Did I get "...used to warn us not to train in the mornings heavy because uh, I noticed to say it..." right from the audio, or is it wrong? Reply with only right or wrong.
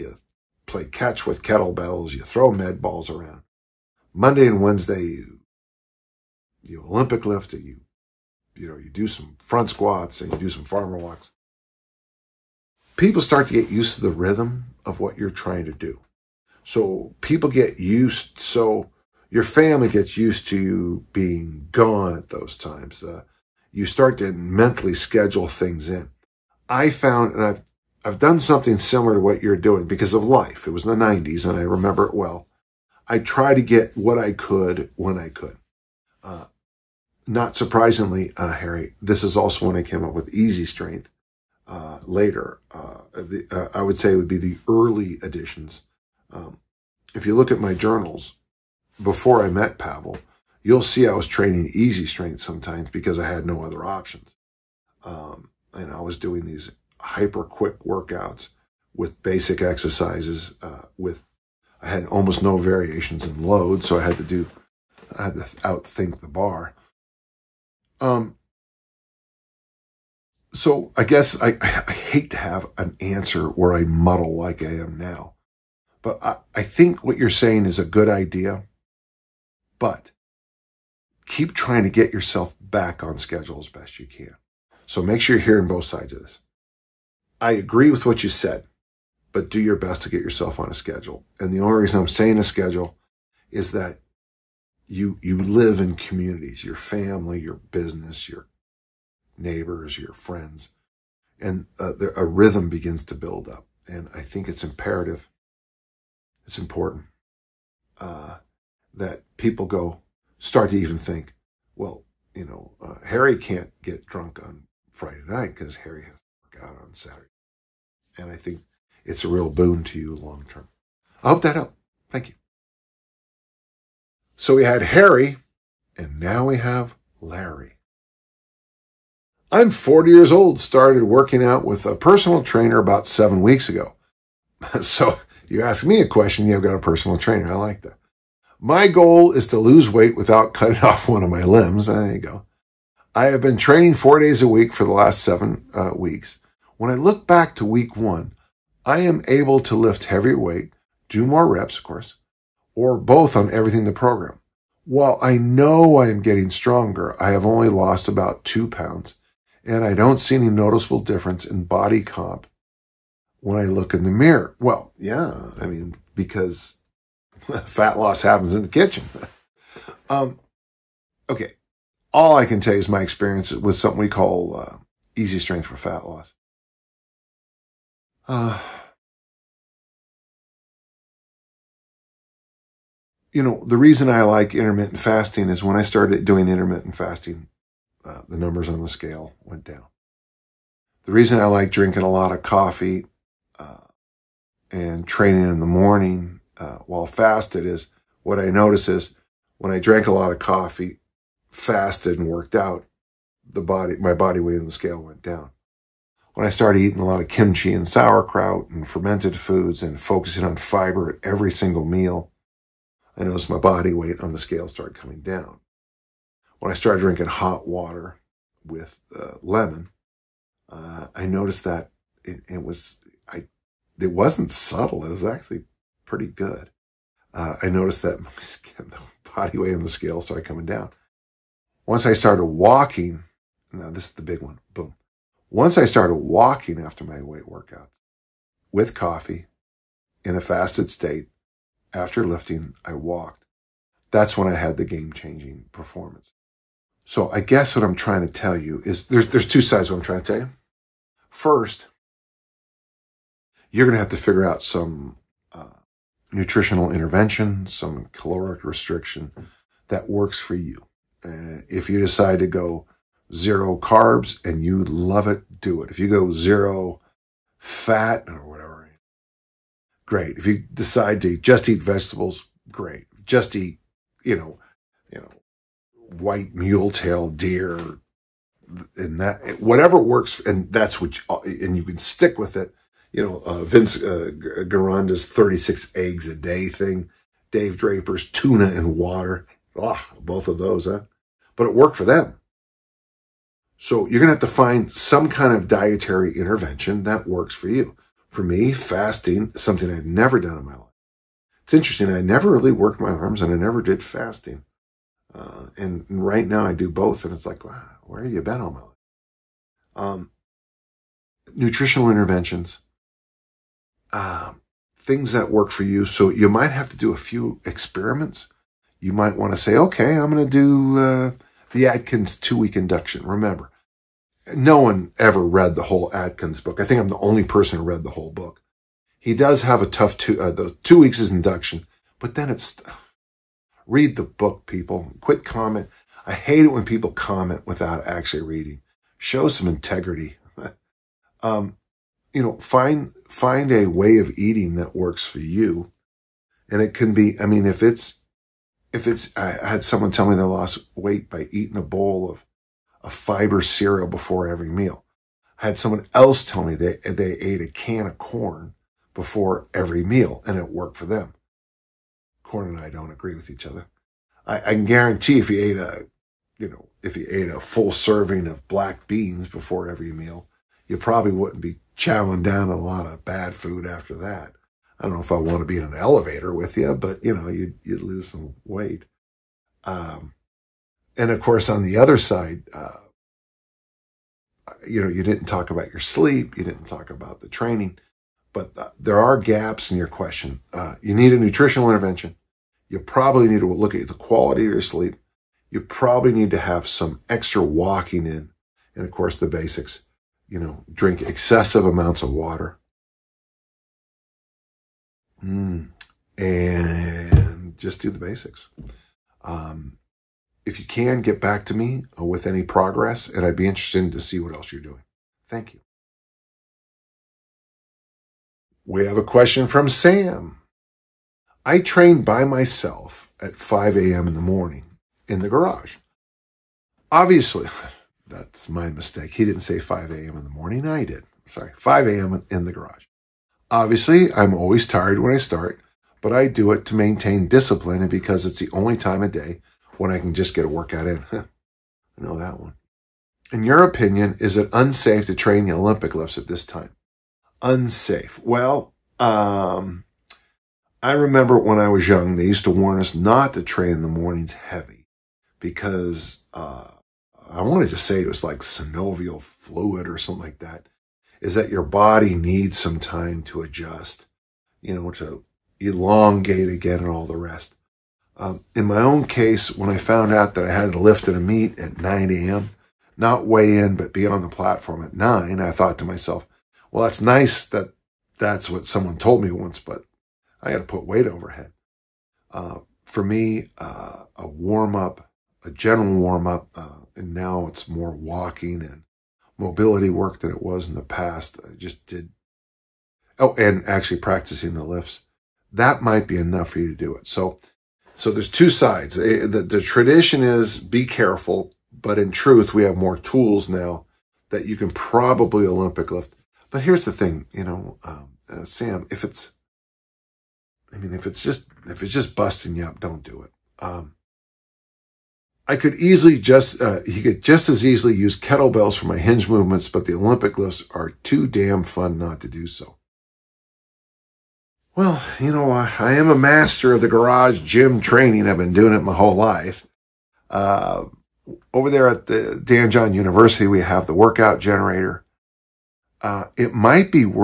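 wrong.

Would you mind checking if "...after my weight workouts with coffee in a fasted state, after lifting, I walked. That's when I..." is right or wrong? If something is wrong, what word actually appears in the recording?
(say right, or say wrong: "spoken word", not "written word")
right.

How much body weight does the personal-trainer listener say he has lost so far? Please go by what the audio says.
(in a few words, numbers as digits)
2 pounds.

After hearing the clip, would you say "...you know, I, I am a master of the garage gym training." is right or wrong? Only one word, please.
right.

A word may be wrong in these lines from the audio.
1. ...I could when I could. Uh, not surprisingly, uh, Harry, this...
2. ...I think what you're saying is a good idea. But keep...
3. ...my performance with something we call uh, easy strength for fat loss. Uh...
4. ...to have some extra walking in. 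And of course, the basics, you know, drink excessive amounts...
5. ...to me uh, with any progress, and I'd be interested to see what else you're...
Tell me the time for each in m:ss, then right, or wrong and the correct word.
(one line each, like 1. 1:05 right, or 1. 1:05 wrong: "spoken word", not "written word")
1. 0:34 right
2. 1:16 right
3. 2:52 wrong: "experience", not "performance"
4. 6:36 right
5. 6:51 right.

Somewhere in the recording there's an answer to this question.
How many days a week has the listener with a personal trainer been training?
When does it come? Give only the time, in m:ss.
2:23.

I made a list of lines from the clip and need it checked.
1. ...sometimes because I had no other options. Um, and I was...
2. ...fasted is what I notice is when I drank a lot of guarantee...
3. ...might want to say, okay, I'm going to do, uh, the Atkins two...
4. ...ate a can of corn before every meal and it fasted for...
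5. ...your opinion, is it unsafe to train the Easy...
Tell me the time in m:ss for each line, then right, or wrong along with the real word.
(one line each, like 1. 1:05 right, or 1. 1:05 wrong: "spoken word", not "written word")
1. 0:52 right
2. 3:17 wrong: "coffee", not "guarantee"
3. 5:19 right
4. 5:57 wrong: "worked", not "fasted"
5. 7:23 wrong: "Olympic", not "Easy".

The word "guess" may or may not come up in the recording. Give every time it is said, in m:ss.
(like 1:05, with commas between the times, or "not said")
1:11, 4:07.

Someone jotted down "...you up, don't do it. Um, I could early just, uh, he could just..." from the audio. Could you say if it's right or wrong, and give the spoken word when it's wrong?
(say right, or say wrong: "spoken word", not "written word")
wrong: "easily", not "early".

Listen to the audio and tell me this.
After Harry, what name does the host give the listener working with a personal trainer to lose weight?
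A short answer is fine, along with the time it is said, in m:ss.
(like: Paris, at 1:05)
Larry, at 2:07.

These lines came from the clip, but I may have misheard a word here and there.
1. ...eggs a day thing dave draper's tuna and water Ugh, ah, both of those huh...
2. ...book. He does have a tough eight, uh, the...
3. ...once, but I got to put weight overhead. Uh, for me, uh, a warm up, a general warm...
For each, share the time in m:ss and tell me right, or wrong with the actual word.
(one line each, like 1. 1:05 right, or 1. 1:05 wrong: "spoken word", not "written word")
1. 4:45 right
2. 5:28 wrong: "two", not "eight"
3. 7:59 right.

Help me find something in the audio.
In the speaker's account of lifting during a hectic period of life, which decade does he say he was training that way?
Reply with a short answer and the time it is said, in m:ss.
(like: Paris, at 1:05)
the 90s, at 0:30.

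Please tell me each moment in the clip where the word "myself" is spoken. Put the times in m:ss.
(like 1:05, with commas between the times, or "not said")
7:02, 7:56.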